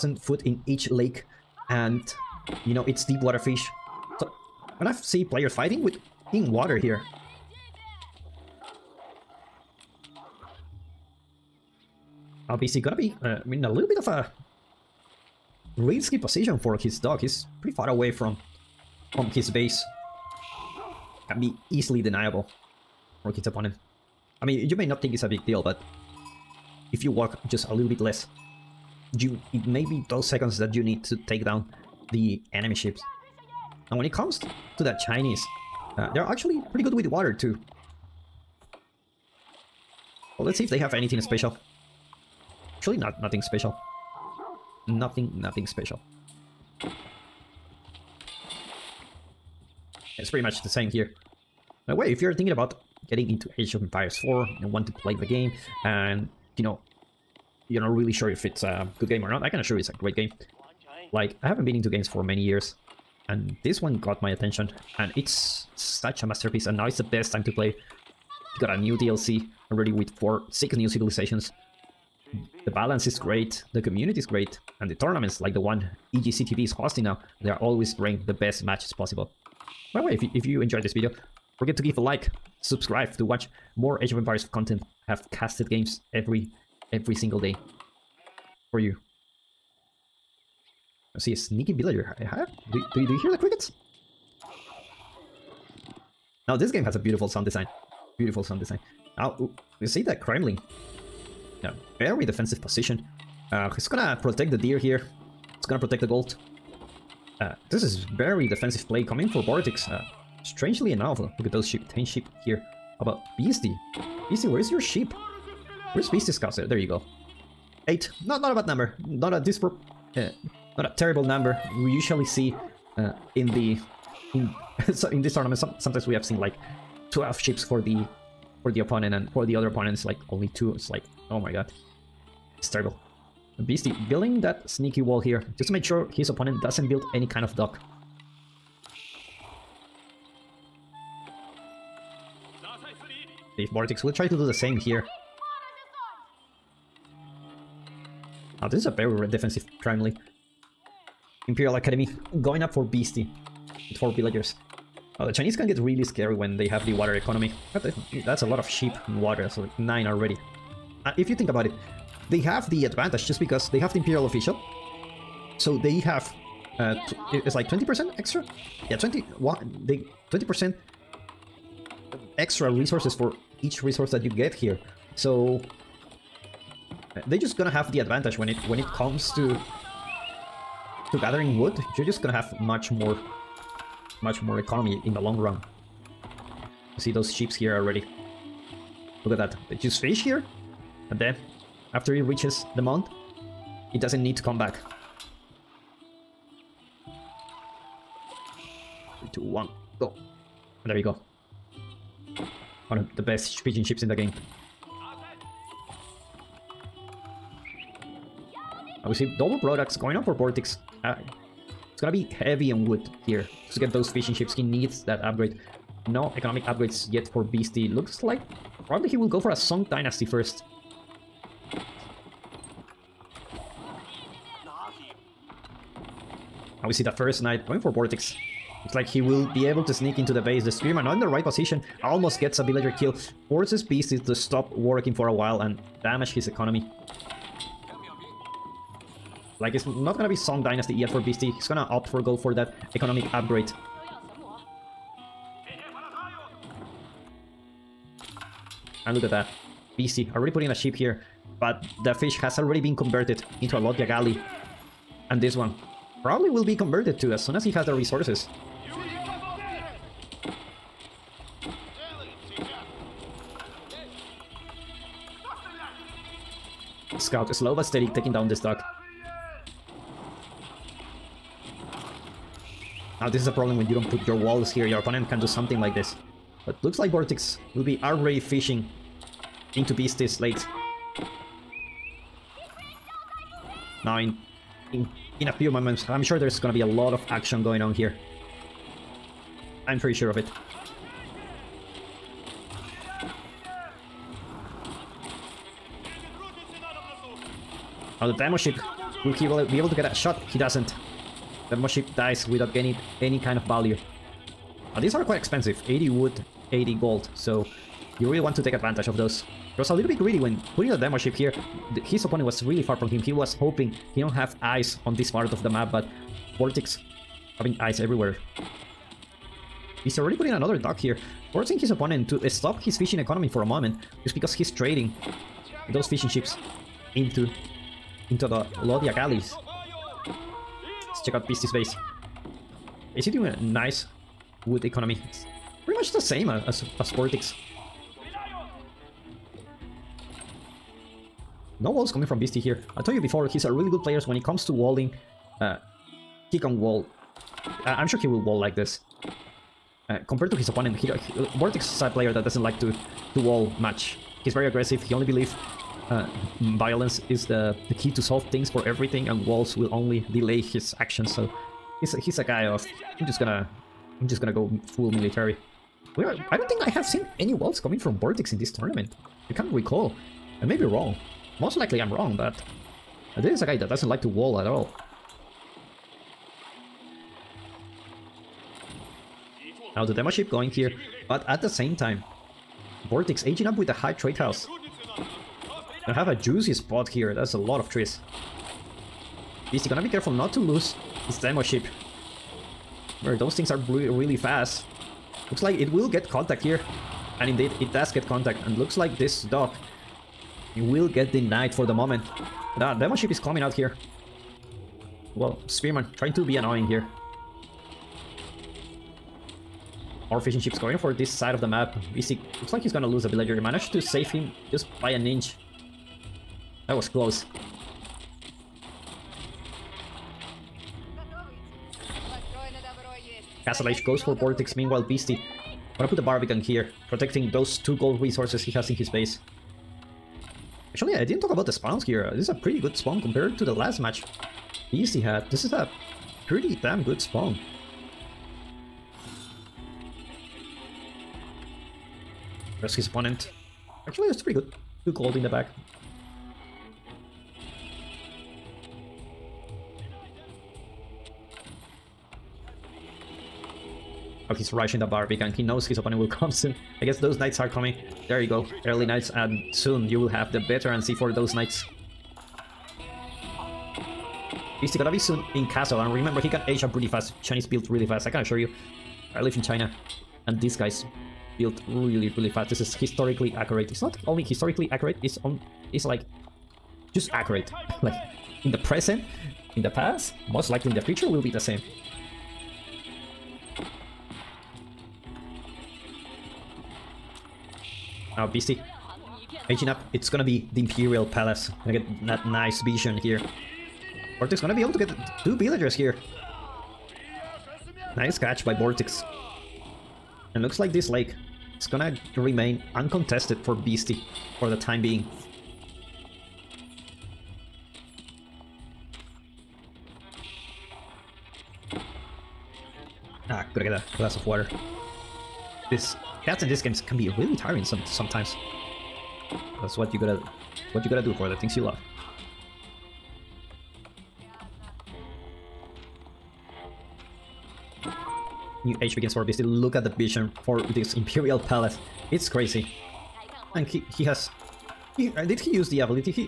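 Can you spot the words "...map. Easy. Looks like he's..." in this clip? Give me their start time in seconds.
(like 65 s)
411 s.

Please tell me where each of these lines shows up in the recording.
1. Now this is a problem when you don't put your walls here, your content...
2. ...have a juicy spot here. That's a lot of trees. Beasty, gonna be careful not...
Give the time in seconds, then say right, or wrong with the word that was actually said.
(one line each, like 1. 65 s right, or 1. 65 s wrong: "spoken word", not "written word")
1. 273 s wrong: "opponent", not "content"
2. 386 s right.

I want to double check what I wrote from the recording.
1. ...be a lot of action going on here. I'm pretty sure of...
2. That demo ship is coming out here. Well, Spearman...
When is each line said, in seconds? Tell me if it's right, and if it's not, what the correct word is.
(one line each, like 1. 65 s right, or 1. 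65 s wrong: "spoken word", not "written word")
1. 286 s right
2. 402 s right.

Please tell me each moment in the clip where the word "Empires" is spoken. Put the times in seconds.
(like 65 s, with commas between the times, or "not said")
53 s, 84 s.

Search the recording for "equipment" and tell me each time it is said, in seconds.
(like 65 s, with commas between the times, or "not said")
not said.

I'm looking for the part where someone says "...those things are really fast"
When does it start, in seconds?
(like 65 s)
393 s.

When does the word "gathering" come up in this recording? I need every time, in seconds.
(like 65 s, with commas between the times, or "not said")
181 s.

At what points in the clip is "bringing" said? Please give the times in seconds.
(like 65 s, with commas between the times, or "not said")
77 s.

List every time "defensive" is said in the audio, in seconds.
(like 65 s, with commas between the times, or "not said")
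102 s, 108 s, 149 s.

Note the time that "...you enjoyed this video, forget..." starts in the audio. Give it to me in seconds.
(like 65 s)
80 s.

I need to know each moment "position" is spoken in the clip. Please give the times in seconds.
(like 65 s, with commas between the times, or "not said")
16 s, 102 s, 231 s.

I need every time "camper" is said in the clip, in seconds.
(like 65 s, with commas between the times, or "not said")
not said.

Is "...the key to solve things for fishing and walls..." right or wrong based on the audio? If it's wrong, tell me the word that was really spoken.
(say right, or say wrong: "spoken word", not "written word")
wrong: "everything", not "fishing".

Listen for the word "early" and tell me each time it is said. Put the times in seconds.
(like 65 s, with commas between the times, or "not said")
458 s.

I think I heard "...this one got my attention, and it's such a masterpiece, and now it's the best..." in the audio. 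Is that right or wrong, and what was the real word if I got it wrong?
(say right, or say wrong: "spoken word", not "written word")
right.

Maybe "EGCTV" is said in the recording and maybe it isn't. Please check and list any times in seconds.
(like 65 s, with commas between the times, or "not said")
76 s.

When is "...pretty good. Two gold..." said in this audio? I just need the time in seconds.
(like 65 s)
444 s.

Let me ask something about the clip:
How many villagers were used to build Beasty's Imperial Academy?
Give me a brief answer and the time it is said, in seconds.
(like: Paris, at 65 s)
4, at 153 s.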